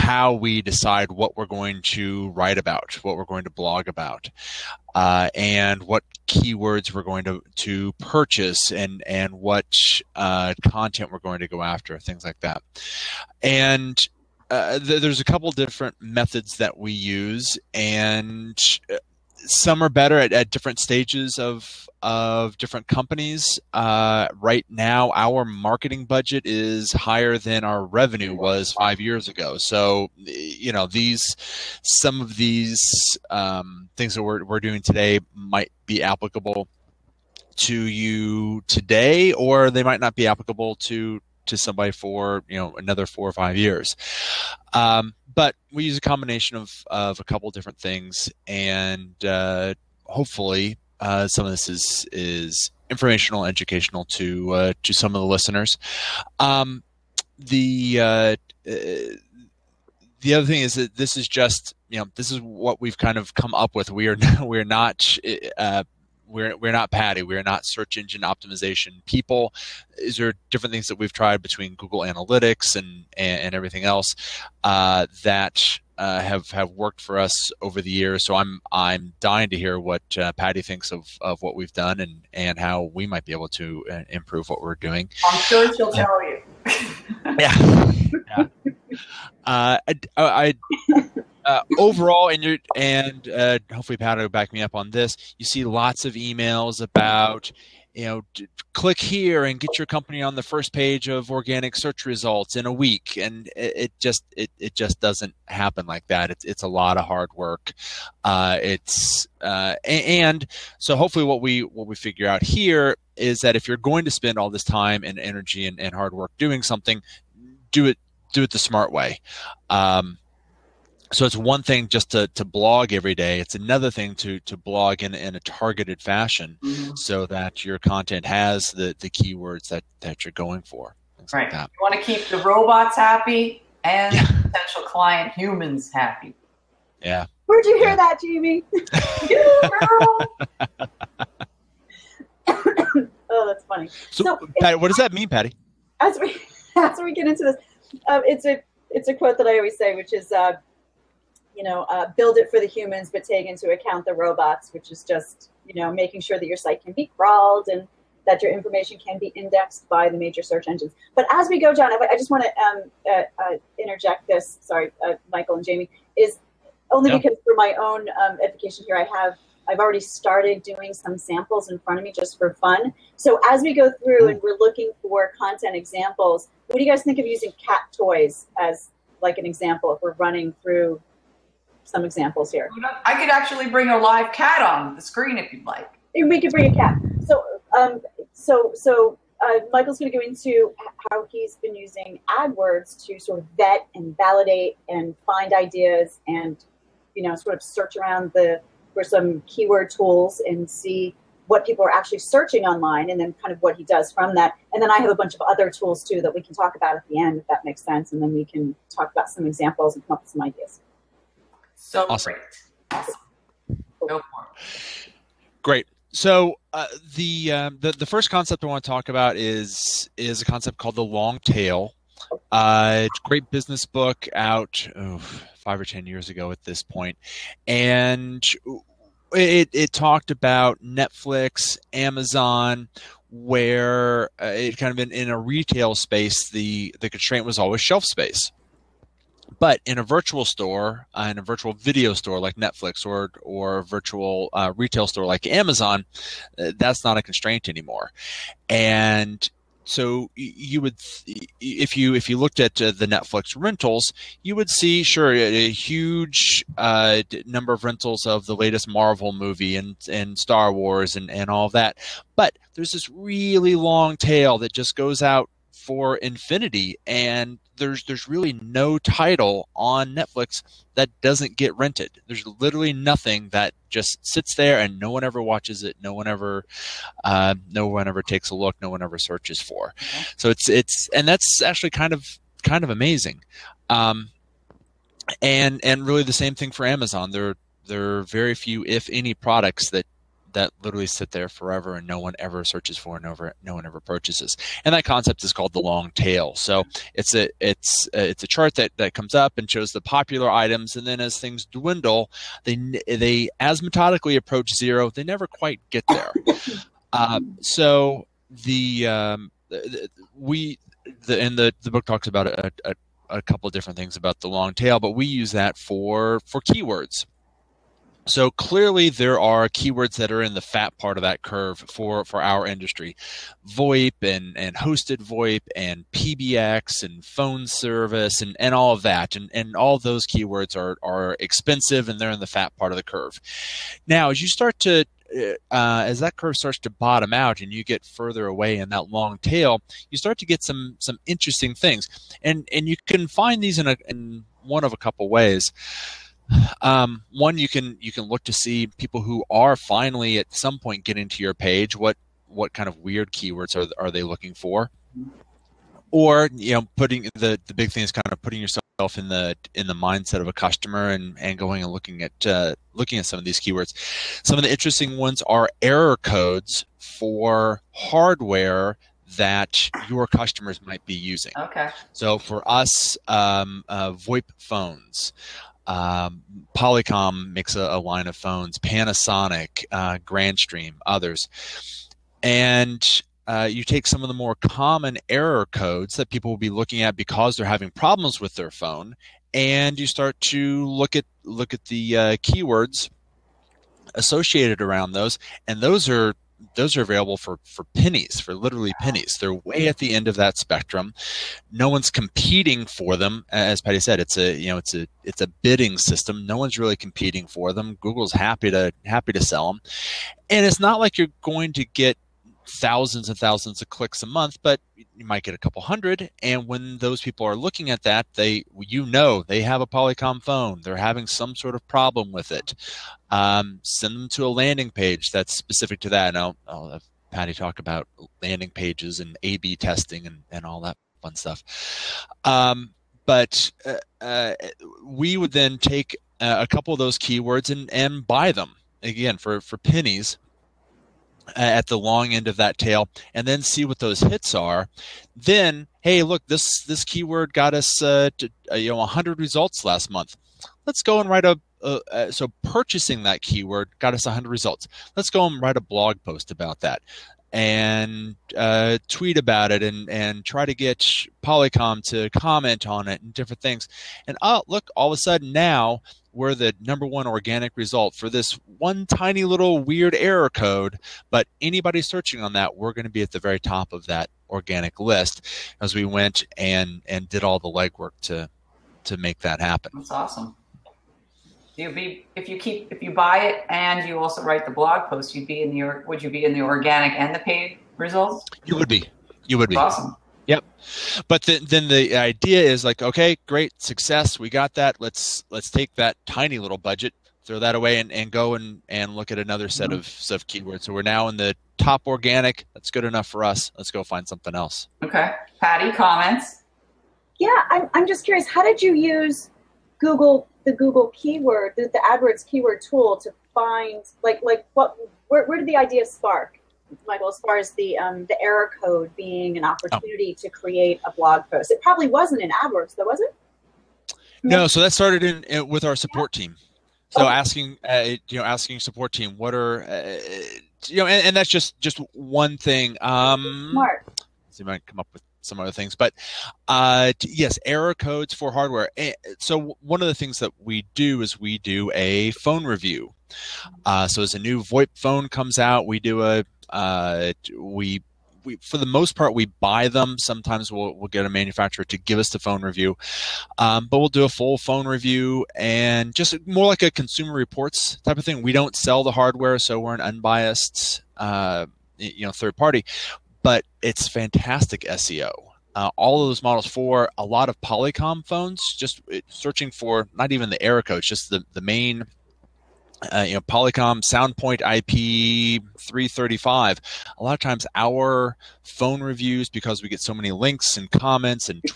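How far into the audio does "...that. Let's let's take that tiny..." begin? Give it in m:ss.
8:14.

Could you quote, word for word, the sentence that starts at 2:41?
But as we go, John, I, I just want to um, uh, uh, interject this.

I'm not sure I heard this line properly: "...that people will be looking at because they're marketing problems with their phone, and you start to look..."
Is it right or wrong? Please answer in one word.
wrong.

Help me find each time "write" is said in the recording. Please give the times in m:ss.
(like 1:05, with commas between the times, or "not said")
0:02, 7:31, 7:35, 8:04.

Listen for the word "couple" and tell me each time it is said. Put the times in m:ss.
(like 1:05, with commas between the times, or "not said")
0:15, 0:47, 5:13, 5:44, 6:55, 7:16.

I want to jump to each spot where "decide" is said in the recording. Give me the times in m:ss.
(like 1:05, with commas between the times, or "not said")
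0:00.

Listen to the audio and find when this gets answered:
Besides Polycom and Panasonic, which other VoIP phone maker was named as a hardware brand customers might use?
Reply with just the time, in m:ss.
6:20.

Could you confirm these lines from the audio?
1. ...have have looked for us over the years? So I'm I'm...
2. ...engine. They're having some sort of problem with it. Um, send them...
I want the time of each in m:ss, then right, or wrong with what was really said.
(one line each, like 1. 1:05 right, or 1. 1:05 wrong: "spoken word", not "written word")
1. 1:16 wrong: "worked", not "looked"
2. 7:00 wrong: "phone", not "engine".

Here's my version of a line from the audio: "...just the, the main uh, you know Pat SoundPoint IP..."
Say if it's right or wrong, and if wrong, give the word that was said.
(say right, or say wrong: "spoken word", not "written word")
wrong: "Polycom", not "Pat".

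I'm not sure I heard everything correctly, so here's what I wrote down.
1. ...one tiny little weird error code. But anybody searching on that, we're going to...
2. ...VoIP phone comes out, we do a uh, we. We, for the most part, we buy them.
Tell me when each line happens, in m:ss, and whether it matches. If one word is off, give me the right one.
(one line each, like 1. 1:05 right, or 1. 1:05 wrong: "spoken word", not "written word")
1. 7:48 right
2. 9:04 right.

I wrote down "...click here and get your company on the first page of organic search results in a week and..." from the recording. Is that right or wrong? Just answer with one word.
right.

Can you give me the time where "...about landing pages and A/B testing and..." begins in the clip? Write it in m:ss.
7:07.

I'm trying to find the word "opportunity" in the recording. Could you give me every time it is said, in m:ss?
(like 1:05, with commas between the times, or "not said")
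8:39.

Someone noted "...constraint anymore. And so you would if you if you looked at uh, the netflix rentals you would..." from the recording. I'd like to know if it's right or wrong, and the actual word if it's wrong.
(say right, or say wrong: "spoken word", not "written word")
right.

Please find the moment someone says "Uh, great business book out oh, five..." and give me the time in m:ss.
3:42.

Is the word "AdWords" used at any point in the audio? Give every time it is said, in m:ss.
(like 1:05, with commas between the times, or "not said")
3:12, 8:32, 8:42.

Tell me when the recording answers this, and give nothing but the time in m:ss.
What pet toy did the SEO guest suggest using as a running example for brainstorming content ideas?
2:57.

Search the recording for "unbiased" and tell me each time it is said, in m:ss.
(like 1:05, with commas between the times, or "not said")
9:20.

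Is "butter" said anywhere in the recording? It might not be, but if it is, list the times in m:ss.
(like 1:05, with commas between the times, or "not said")
not said.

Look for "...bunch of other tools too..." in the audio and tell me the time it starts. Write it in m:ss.
3:25.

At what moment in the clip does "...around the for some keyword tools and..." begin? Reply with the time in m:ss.
3:17.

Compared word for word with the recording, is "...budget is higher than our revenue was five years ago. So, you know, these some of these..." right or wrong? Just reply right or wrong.
right.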